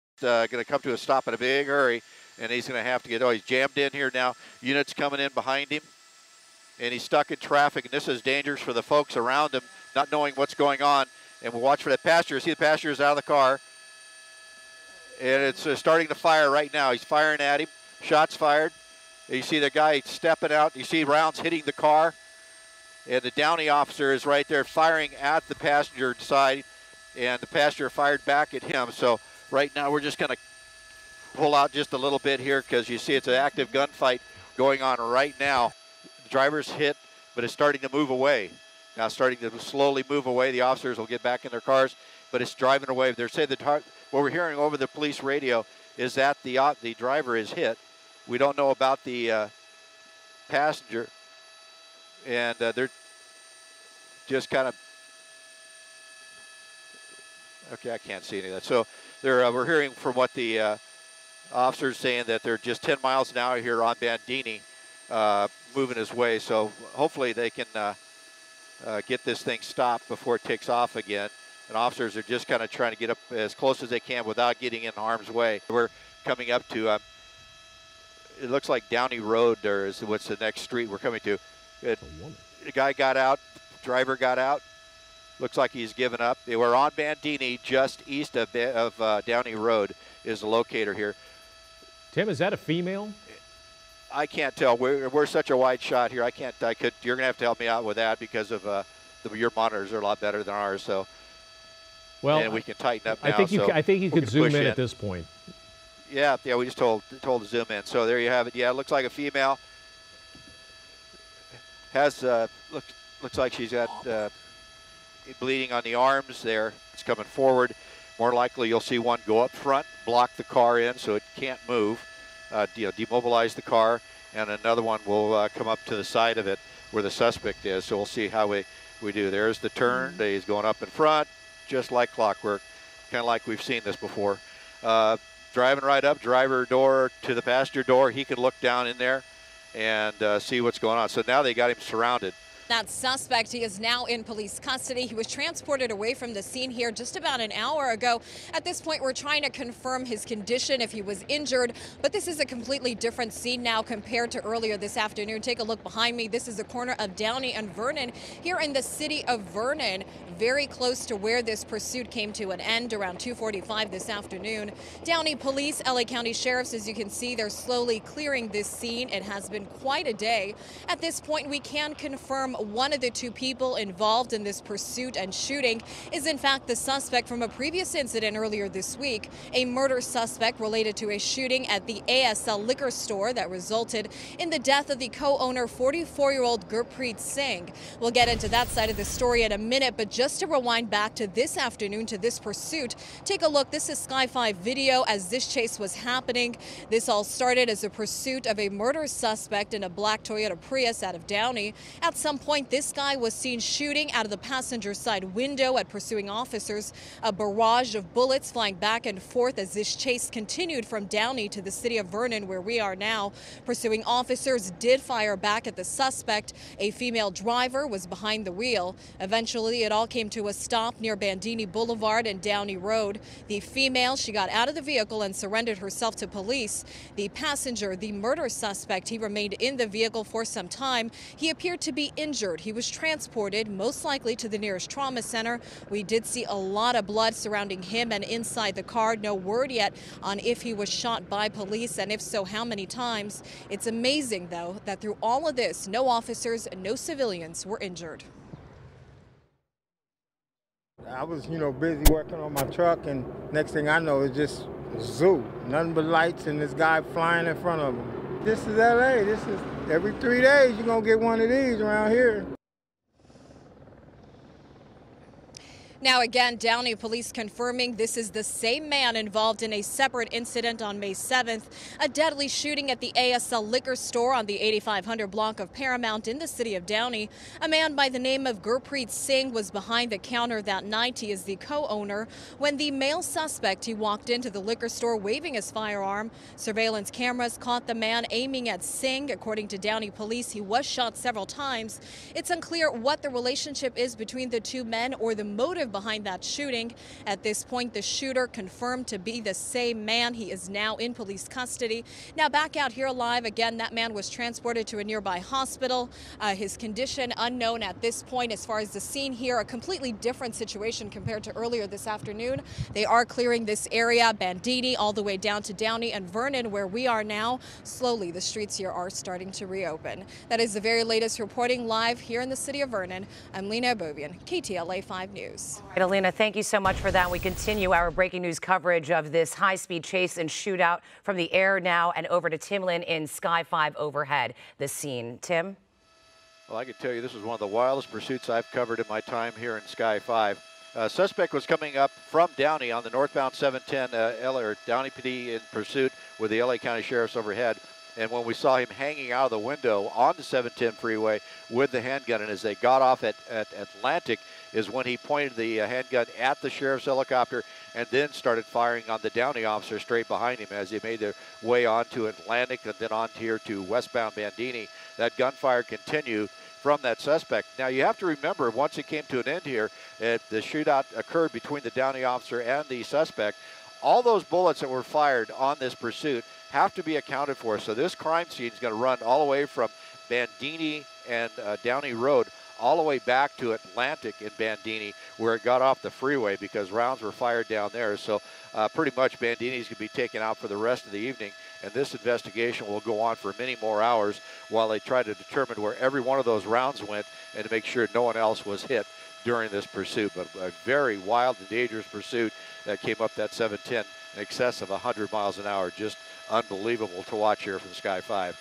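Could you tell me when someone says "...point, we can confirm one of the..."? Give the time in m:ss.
2:51.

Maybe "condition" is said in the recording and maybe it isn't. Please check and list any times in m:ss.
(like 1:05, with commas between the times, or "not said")
2:30, 5:06.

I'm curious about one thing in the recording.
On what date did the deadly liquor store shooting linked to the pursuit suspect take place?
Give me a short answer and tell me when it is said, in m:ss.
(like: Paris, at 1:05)
May 7th, at 4:30.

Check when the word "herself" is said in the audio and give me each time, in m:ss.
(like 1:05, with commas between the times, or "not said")
3:45.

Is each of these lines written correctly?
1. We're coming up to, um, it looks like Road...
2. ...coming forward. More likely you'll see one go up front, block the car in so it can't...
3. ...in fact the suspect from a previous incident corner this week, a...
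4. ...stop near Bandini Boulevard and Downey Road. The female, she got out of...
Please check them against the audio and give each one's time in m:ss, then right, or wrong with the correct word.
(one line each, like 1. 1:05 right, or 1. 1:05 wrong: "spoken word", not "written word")
1. 1:15 wrong: "Downey", not "Road"
2. 1:57 right
3. 2:56 wrong: "earlier", not "corner"
4. 3:40 right.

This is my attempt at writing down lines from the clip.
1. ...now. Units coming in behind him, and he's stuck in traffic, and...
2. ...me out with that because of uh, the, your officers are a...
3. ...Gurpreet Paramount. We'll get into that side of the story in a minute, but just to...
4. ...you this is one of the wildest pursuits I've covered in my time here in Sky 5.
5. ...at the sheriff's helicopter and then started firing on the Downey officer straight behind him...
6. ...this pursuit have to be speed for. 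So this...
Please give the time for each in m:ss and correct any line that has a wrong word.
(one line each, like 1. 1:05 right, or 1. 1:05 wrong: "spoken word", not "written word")
1. 0:04 right
2. 1:37 wrong: "monitors", not "officers"
3. 3:06 wrong: "Singh", not "Paramount"
4. 5:37 right
5. 5:56 right
6. 6:15 wrong: "accounted", not "speed".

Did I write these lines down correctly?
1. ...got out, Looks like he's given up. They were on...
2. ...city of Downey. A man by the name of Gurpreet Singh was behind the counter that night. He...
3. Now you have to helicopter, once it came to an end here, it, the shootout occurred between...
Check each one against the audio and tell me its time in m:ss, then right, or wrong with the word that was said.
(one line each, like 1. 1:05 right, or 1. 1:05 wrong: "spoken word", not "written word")
1. 1:24 right
2. 4:36 right
3. 6:07 wrong: "remember", not "helicopter".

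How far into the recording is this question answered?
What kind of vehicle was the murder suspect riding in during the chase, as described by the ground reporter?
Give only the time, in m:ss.
3:19.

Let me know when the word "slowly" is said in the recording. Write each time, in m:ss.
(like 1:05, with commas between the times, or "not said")
0:39, 2:47, 5:17.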